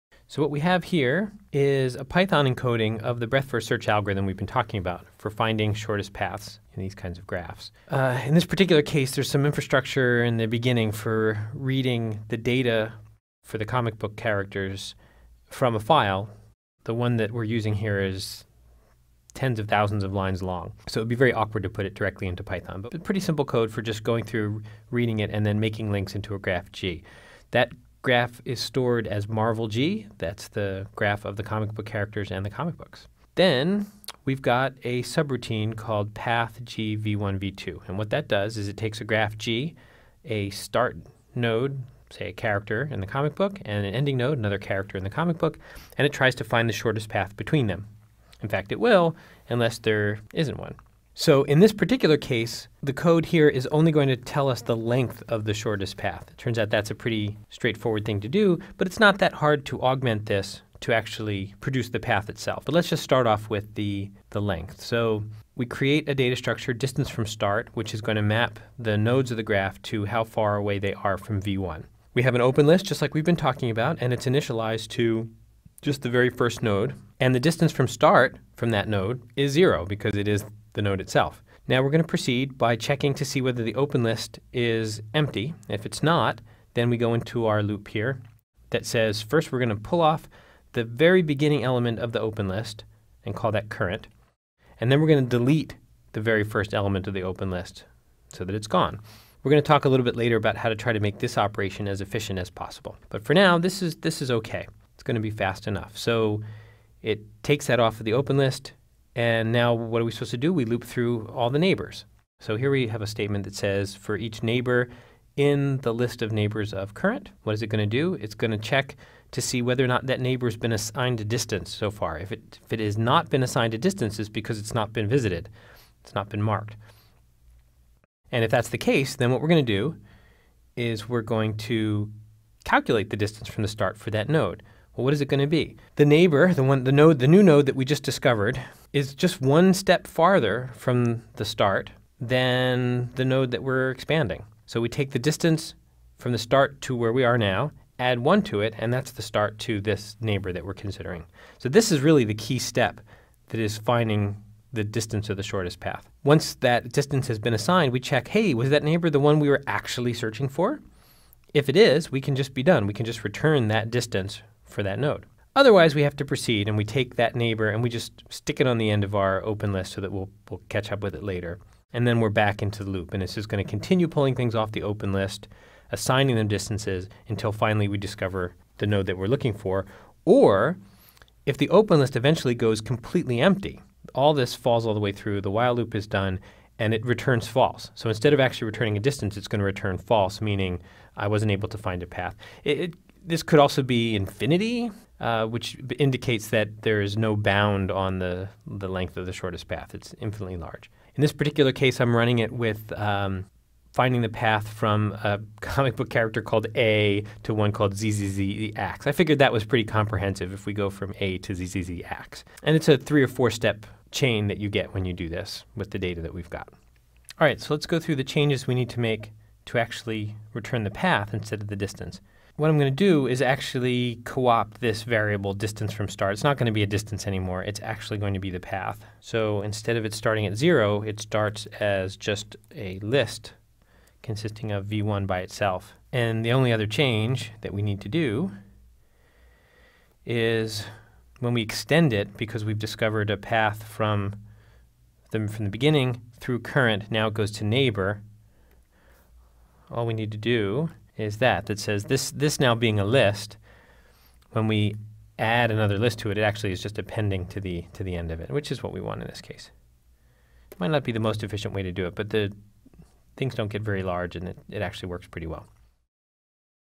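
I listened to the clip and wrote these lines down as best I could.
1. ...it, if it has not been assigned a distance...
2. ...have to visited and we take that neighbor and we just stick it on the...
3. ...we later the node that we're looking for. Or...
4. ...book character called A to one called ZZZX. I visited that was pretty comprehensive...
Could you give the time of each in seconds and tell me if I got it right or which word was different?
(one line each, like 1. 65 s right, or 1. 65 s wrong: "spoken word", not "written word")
1. 122 s right
2. 166 s wrong: "proceed", not "visited"
3. 177 s wrong: "discover", not "later"
4. 205 s wrong: "figured", not "visited".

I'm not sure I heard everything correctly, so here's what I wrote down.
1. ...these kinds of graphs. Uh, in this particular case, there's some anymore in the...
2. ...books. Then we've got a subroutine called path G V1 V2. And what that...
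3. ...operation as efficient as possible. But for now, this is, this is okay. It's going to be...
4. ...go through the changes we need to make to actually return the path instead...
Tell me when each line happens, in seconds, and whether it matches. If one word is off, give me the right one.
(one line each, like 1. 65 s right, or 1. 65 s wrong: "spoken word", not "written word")
1. 6 s wrong: "infrastructure", not "anymore"
2. 32 s right
3. 101 s right
4. 217 s right.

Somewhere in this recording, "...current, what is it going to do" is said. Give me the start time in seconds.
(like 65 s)
116 s.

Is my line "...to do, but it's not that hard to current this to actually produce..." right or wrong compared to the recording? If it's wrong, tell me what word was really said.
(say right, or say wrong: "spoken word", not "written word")
wrong: "augment", not "current".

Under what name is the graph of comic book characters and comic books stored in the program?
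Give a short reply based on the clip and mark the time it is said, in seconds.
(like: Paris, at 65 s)
Marvel G, at 29 s.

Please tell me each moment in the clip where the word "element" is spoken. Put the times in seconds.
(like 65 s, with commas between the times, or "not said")
91 s, 96 s.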